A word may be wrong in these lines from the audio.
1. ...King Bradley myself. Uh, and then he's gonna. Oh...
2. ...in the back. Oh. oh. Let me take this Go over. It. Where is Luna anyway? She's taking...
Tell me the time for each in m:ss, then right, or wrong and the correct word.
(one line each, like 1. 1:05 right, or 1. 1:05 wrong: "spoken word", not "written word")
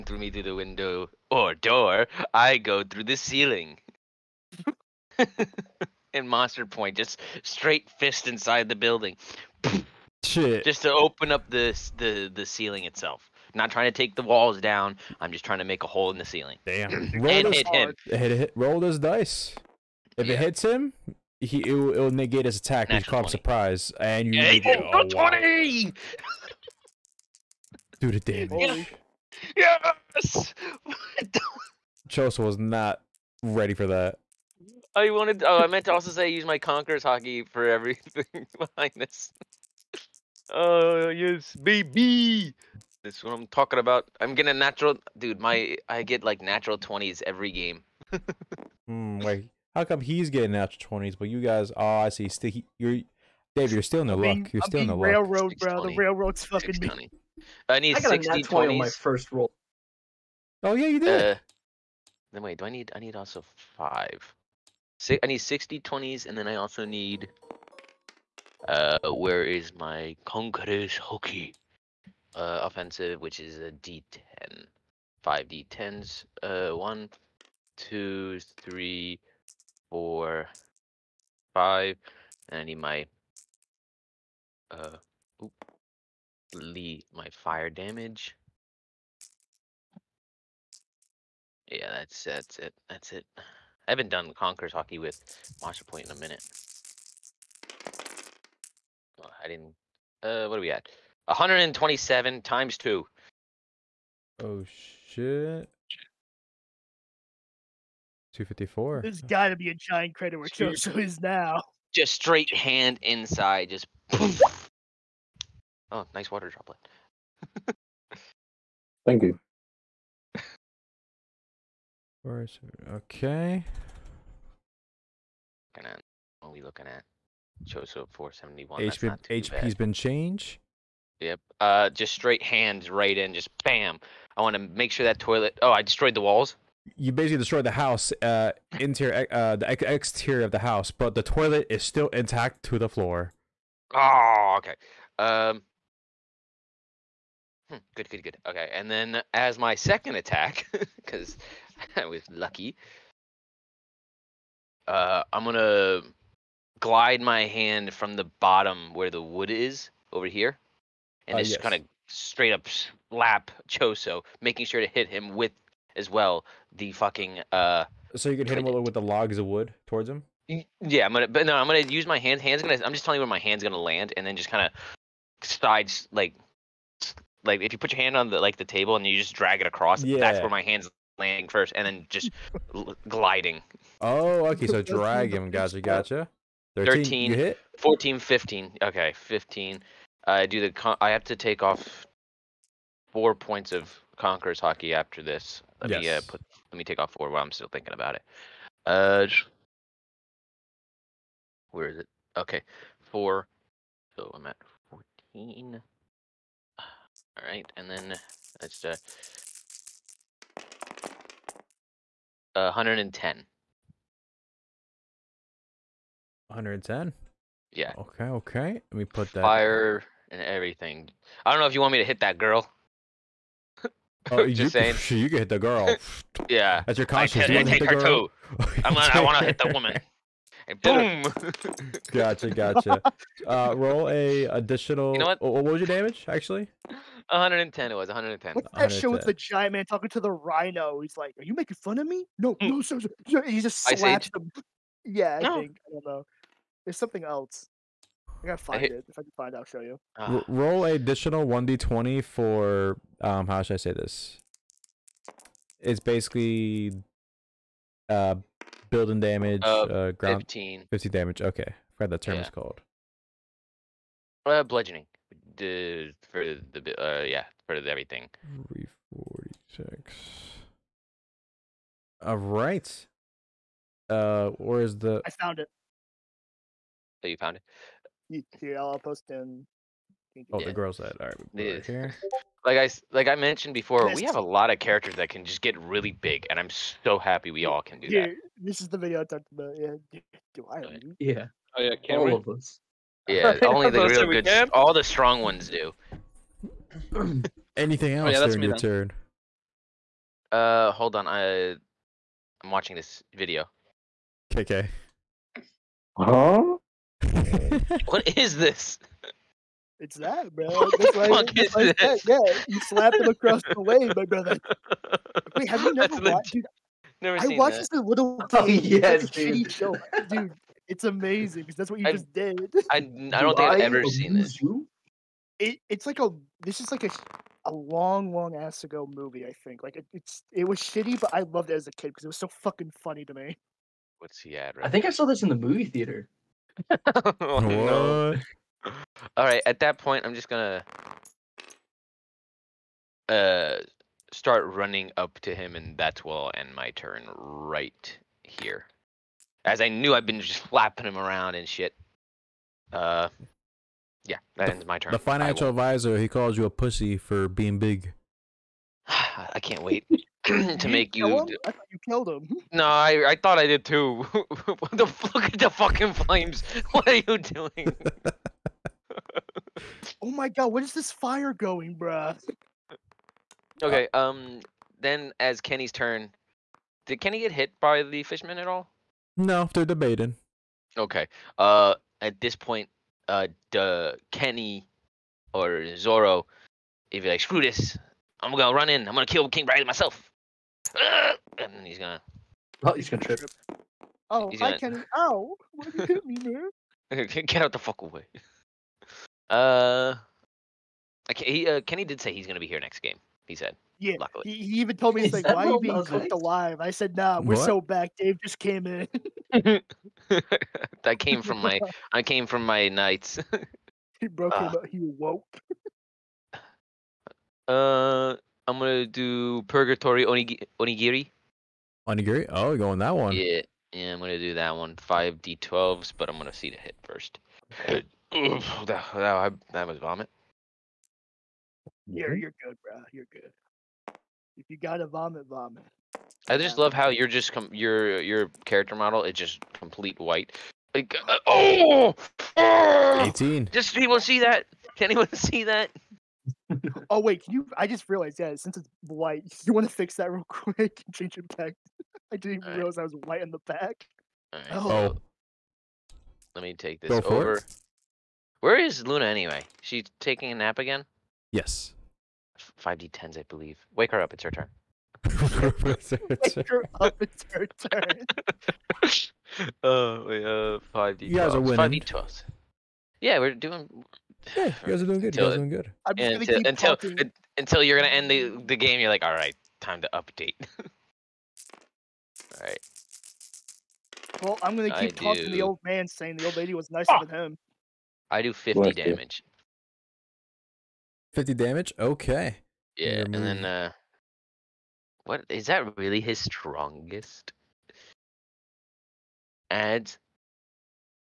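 1. 6:29 right
2. 7:33 right.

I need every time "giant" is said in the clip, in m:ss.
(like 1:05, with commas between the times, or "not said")
1:49, 3:59.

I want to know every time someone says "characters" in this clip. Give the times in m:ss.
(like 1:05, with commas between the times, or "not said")
4:44, 7:18.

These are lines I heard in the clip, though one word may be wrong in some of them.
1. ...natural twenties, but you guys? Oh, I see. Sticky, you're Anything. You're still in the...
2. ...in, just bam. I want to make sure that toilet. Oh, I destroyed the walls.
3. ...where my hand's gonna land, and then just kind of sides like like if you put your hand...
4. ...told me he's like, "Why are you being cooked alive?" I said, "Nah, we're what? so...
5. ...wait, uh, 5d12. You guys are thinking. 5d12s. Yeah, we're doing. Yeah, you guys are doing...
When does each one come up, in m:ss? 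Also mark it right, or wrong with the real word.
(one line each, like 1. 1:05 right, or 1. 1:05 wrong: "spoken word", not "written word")
1. 0:50 wrong: "Dave", not "Anything"
2. 2:13 right
3. 2:53 right
4. 6:44 right
5. 7:50 wrong: "winning", not "thinking".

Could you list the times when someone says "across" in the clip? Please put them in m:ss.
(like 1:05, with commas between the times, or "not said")
2:59, 5:13.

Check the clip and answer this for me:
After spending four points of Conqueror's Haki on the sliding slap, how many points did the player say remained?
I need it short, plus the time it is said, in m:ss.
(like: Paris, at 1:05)
14, at 3:24.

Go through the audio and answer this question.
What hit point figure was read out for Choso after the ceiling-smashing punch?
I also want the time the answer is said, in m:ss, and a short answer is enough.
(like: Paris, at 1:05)
471, at 2:08.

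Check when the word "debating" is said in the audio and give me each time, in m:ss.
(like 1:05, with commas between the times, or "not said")
6:19.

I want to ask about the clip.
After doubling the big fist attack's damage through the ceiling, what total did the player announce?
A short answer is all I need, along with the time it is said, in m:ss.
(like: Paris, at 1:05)
254, at 1:48.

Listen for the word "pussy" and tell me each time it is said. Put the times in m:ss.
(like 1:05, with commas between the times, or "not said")
5:56.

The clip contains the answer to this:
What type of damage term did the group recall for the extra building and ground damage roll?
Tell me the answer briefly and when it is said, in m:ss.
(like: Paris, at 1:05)
bludgeoning, at 4:24.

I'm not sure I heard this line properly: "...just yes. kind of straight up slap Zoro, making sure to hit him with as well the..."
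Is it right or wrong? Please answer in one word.
wrong.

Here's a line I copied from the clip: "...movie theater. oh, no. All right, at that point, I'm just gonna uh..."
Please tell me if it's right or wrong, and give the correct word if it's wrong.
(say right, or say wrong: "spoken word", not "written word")
right.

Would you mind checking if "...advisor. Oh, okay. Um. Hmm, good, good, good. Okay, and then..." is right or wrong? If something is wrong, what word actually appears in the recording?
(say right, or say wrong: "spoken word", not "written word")
wrong: "floor", not "advisor".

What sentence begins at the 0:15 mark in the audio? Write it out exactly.
I'm just trying to make a hole in the ceiling.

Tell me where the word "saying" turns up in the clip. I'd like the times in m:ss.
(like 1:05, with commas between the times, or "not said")
3:44, 8:06.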